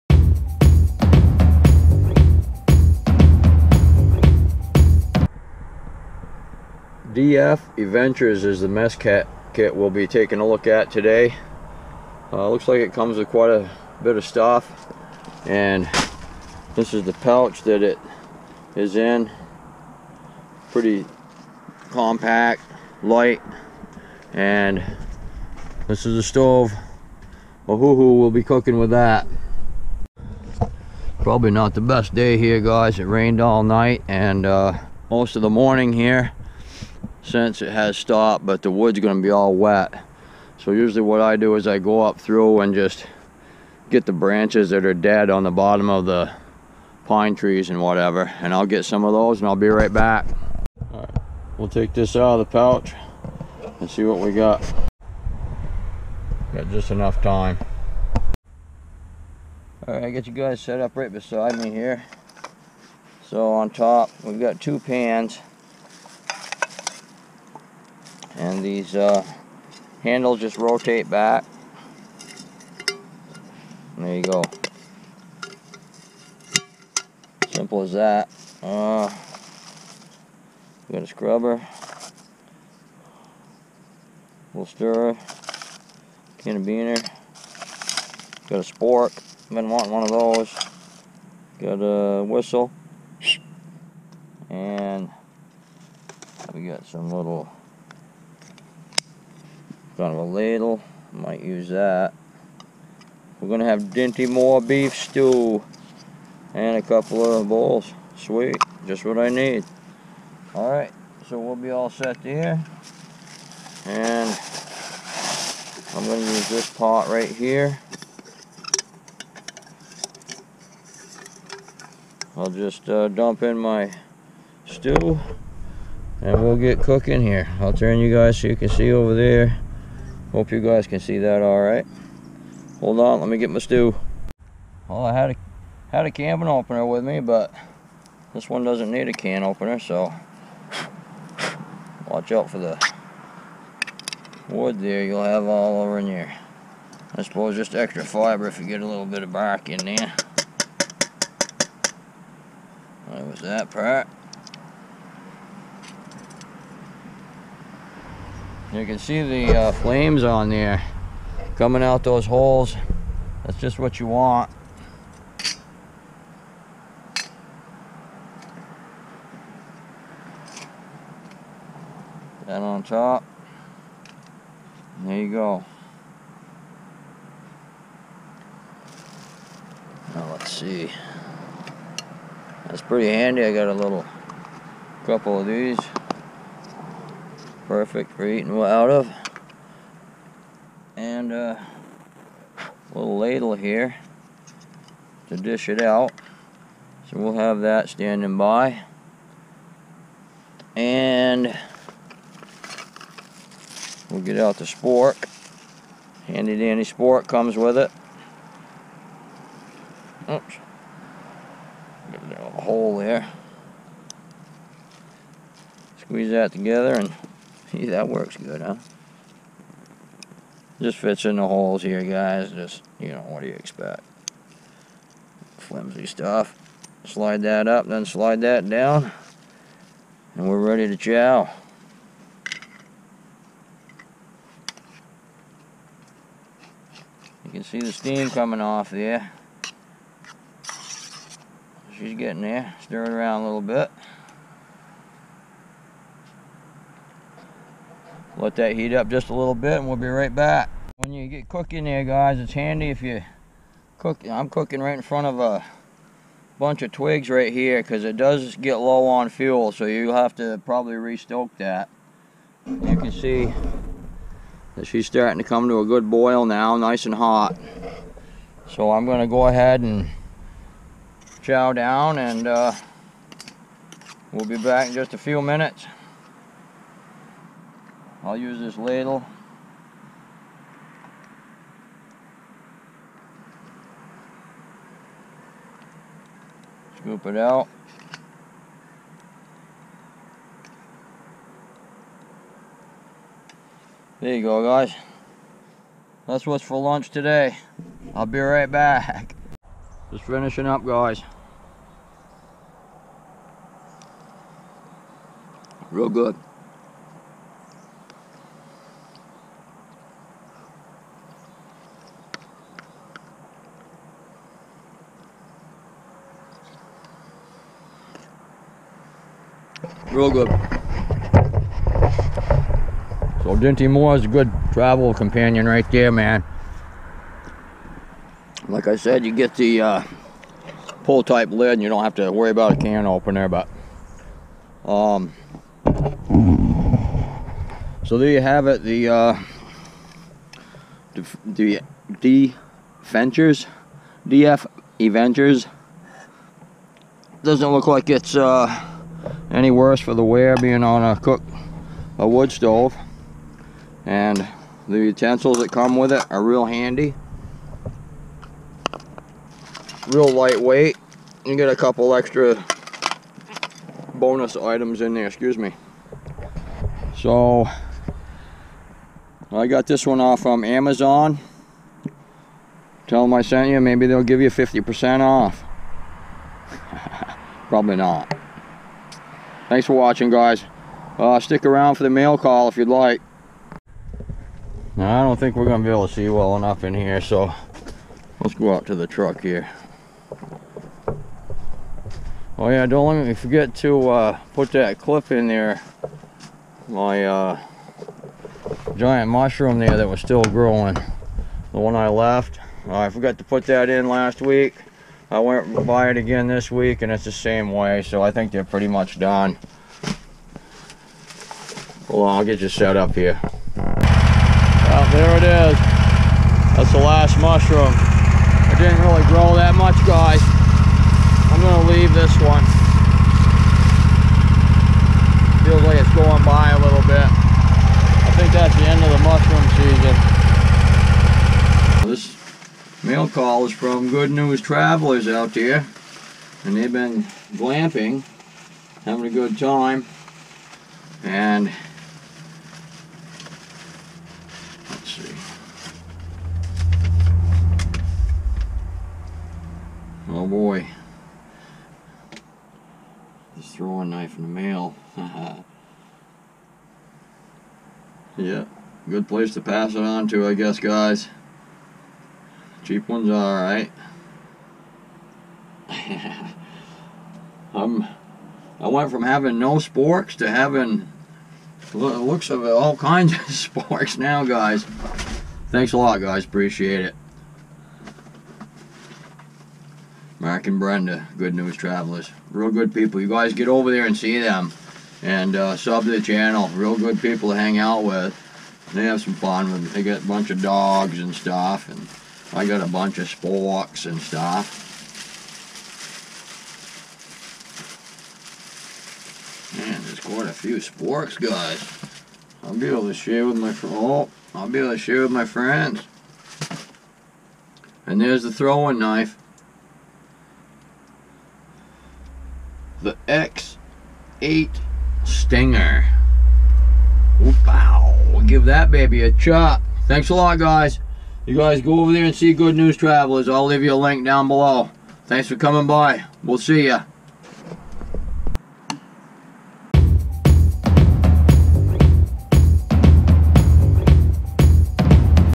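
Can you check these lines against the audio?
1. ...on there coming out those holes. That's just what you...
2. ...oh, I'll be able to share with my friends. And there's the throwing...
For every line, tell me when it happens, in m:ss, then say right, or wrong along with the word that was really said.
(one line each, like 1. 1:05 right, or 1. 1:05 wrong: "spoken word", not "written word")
1. 2:40 right
2. 8:23 right.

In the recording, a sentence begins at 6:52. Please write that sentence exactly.
Well, I'll get you set up here.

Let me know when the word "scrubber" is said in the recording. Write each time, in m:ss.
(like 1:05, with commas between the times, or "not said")
1:21.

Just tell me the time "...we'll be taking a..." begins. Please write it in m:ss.
0:09.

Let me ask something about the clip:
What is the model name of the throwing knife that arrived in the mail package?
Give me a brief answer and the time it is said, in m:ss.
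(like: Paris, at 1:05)
X8 Stinger, at 8:33.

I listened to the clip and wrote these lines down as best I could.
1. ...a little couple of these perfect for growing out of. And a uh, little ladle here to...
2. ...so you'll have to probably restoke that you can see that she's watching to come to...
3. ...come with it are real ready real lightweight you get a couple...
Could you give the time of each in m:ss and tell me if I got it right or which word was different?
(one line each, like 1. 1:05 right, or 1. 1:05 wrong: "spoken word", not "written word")
1. 3:03 wrong: "eating", not "growing"
2. 4:19 wrong: "starting", not "watching"
3. 5:55 wrong: "handy", not "ready".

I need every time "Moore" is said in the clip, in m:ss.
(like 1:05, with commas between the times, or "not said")
1:44, 5:23.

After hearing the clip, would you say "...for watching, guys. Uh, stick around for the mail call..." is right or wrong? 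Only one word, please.
right.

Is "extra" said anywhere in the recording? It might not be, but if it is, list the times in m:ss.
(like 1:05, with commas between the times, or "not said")
2:27, 6:02.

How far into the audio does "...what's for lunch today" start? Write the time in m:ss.
4:56.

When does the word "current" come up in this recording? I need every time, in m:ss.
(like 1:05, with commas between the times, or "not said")
not said.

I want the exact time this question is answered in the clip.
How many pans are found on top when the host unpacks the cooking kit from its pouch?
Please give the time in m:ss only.
1:04.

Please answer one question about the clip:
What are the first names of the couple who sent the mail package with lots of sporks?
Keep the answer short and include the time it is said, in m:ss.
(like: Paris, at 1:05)
Mark and Brenda, at 8:00.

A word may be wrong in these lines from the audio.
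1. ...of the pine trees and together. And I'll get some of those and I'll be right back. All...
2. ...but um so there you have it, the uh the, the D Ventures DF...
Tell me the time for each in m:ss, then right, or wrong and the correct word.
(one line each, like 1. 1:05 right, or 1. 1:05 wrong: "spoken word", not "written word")
1. 0:45 wrong: "whatever", not "together"
2. 5:33 right.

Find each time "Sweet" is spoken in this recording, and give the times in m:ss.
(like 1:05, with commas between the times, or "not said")
1:48.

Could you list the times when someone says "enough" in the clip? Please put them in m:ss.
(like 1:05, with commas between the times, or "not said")
0:56, 6:26.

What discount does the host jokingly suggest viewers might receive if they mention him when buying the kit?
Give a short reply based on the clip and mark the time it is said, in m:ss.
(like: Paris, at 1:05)
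50%, at 6:14.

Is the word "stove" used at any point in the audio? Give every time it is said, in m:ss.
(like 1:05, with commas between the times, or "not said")
0:26, 5:52.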